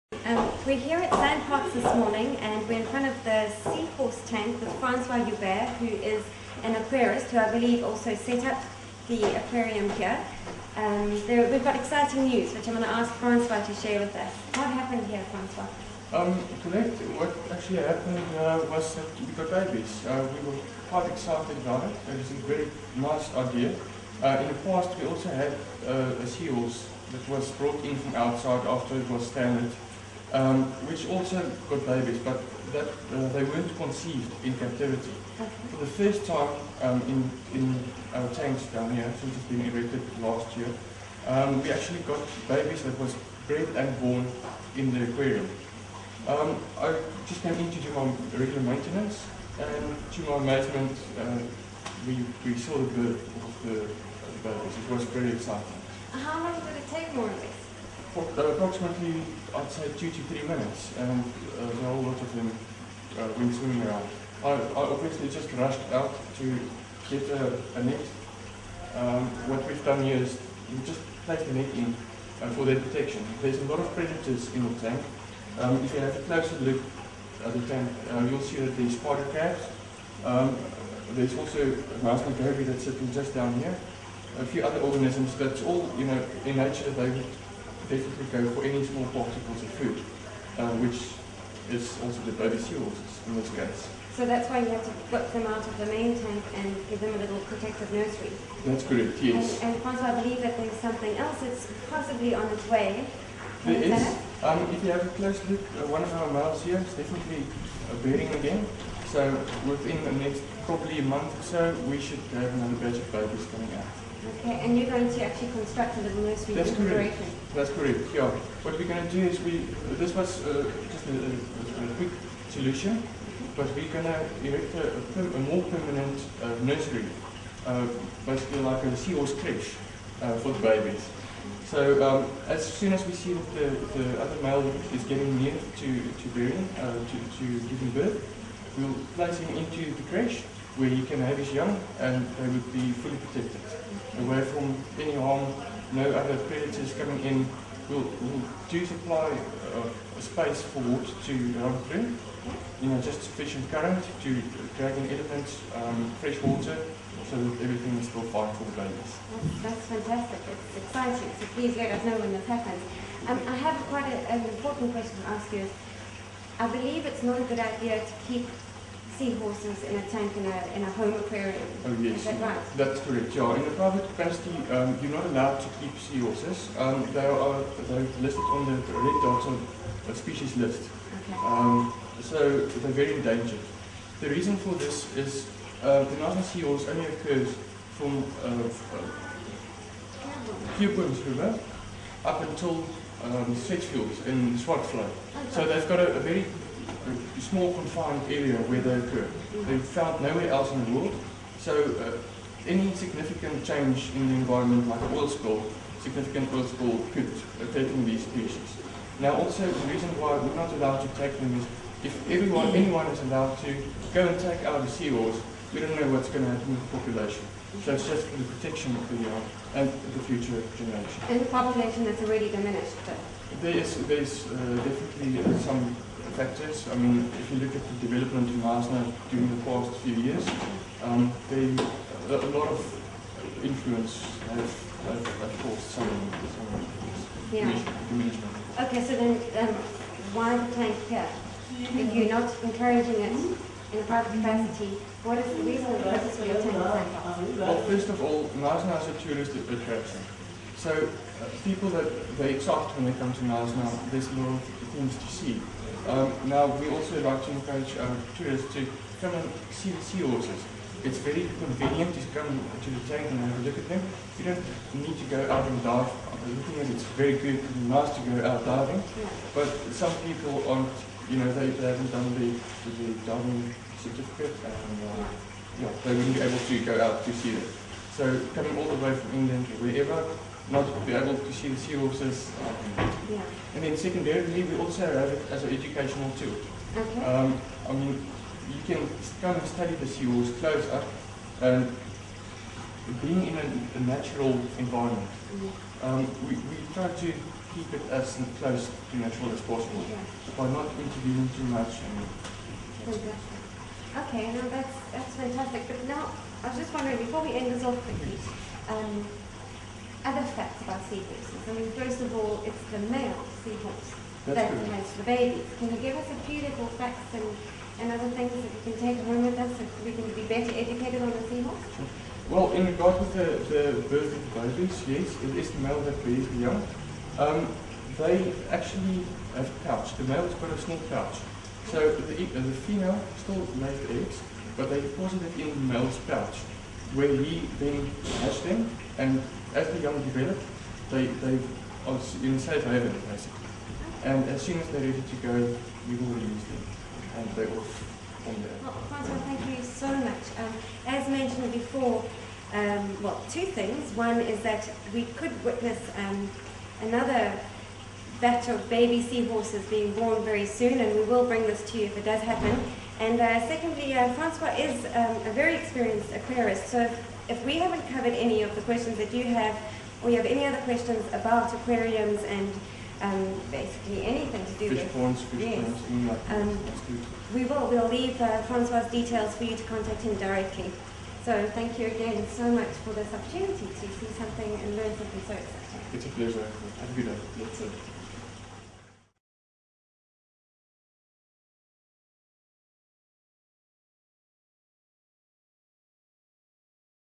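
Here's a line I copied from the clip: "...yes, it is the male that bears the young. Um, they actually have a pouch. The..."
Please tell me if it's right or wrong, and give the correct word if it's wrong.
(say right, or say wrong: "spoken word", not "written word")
right.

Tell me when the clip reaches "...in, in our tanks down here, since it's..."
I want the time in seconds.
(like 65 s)
37 s.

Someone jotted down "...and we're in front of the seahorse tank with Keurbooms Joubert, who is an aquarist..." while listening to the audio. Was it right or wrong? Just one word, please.
wrong.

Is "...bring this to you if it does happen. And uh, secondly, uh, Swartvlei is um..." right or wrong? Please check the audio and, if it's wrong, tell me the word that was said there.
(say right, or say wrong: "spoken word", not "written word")
wrong: "Francois", not "Swartvlei".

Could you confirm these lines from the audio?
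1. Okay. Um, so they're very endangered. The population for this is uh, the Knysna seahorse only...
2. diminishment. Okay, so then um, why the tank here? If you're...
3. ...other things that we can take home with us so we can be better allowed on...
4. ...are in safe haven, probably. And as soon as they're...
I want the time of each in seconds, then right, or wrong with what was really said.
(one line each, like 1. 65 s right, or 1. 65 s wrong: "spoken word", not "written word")
1. 181 s wrong: "reason", not "population"
2. 238 s right
3. 318 s wrong: "educated", not "allowed"
4. 342 s wrong: "basically", not "probably".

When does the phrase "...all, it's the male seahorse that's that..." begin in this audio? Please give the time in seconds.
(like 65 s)
312 s.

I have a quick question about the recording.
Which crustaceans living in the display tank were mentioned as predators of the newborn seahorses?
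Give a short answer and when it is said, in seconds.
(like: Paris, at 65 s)
Spider crabs, at 78 s.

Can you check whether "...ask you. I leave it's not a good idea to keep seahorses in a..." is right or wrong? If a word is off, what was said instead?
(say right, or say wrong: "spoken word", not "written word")
wrong: "believe", not "leave".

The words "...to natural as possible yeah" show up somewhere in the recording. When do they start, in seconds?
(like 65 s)
299 s.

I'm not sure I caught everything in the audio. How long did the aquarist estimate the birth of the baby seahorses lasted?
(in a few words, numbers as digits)
2 to 3 minutes.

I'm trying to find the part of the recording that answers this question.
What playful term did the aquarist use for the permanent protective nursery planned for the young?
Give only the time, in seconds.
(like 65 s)
128 s.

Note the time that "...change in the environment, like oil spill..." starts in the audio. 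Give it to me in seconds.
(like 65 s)
203 s.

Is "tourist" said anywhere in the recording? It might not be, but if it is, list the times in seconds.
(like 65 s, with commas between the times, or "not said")
249 s, 258 s.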